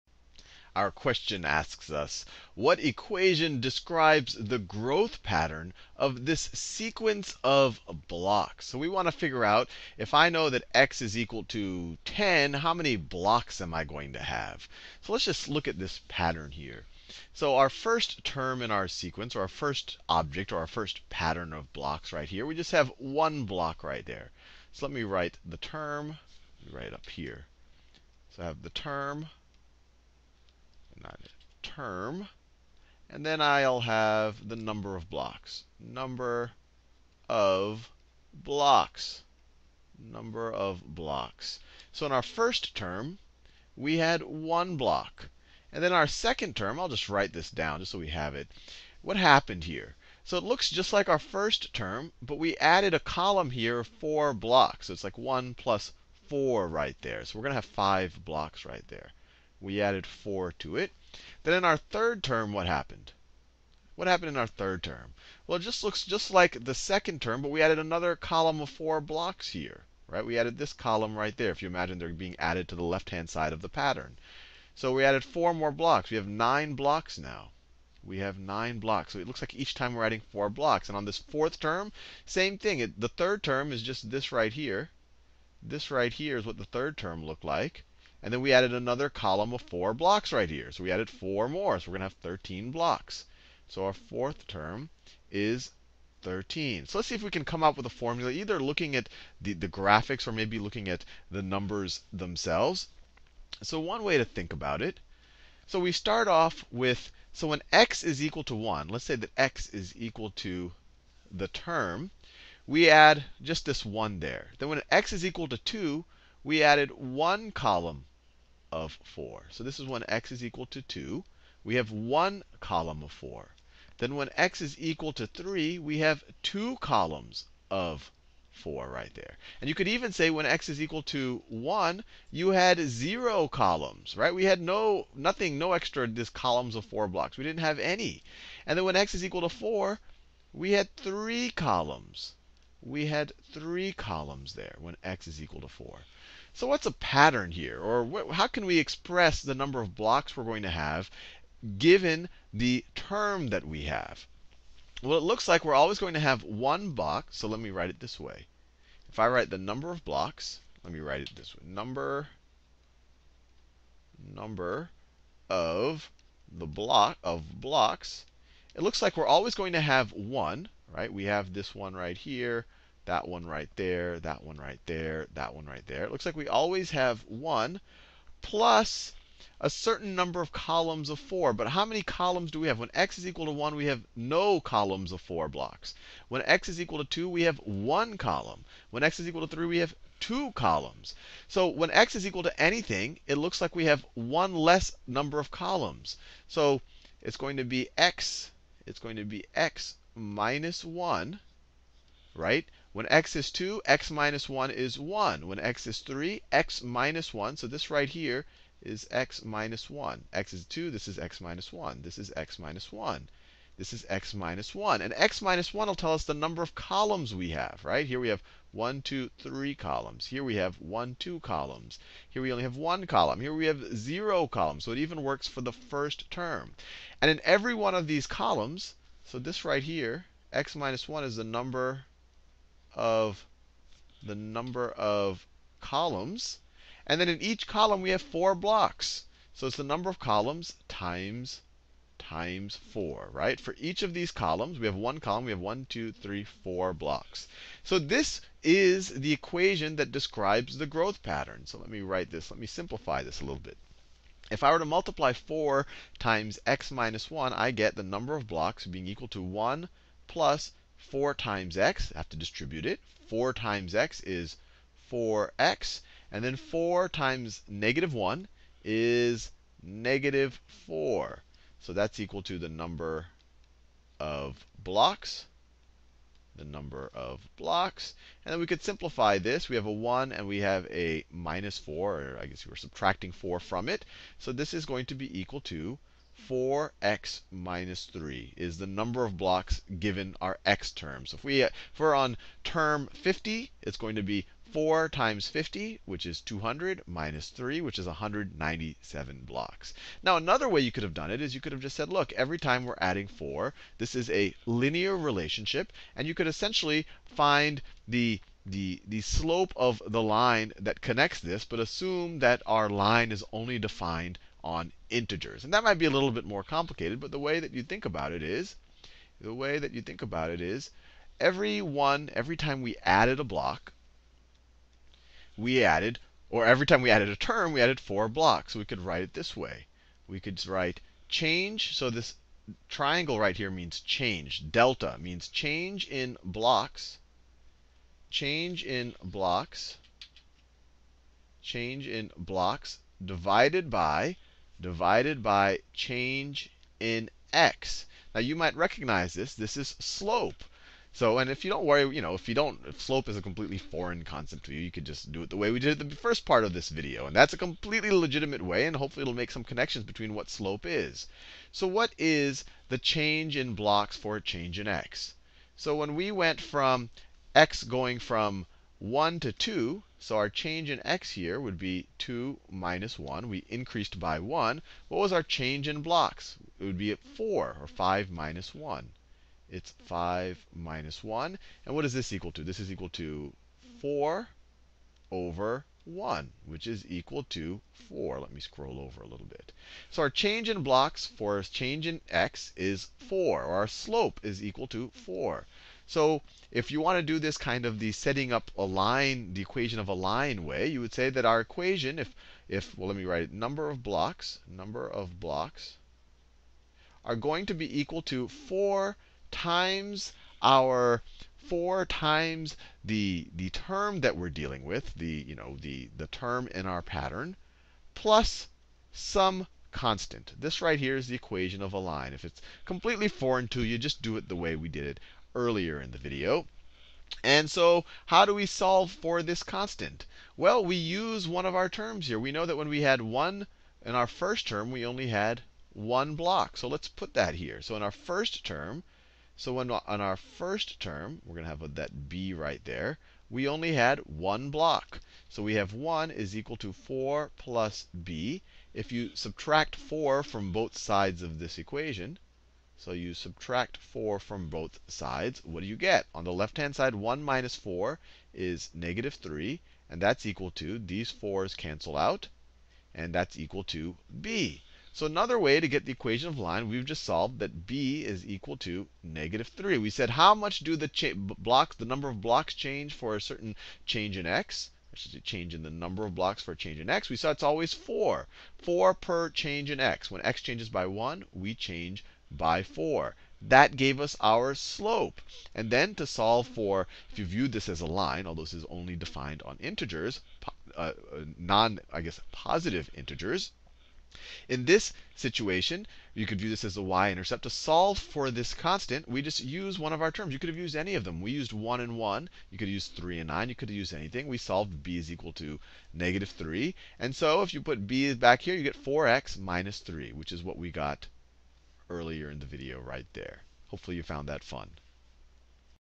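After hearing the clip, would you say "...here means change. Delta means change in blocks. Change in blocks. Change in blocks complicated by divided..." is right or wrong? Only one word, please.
wrong.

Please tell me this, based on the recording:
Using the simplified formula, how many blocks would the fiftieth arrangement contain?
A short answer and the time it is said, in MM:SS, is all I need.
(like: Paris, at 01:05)
197, at 04:58.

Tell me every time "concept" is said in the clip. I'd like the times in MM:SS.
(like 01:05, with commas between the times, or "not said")
05:54.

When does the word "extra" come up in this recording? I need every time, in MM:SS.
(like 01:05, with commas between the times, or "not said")
02:15.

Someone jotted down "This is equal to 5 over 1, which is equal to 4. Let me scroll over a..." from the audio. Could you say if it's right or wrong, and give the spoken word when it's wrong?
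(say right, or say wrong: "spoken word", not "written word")
wrong: "4", not "5".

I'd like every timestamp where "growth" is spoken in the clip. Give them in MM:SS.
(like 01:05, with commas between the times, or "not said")
00:04, 04:10.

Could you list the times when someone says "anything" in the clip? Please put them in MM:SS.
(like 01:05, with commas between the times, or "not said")
03:12, 08:24.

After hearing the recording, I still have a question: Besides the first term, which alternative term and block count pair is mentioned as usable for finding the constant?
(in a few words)
3 and 9.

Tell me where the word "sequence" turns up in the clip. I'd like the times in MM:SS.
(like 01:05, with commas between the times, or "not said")
00:06, 00:18.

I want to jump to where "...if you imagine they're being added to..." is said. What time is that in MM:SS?
01:11.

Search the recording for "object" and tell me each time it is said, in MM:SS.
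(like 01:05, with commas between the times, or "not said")
00:20.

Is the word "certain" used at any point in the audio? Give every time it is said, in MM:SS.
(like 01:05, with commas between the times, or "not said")
02:59, 07:53.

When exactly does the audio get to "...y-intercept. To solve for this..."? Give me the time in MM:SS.
08:17.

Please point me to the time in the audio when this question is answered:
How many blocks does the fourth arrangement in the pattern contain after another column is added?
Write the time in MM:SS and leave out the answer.
01:32.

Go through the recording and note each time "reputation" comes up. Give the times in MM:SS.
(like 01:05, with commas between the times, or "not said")
not said.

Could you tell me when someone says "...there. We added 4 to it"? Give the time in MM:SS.
00:58.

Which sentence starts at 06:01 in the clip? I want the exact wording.
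So what is the change in blocks for a change in x?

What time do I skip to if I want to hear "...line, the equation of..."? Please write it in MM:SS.
06:38.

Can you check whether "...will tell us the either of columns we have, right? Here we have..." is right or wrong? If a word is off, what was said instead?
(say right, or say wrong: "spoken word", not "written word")
wrong: "number", not "either".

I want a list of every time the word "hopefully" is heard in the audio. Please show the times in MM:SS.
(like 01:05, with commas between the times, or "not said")
05:58, 08:33.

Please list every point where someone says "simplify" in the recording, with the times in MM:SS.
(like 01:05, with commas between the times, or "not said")
04:12, 04:38.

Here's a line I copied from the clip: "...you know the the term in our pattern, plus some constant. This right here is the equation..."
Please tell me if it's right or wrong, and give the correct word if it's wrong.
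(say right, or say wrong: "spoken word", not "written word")
right.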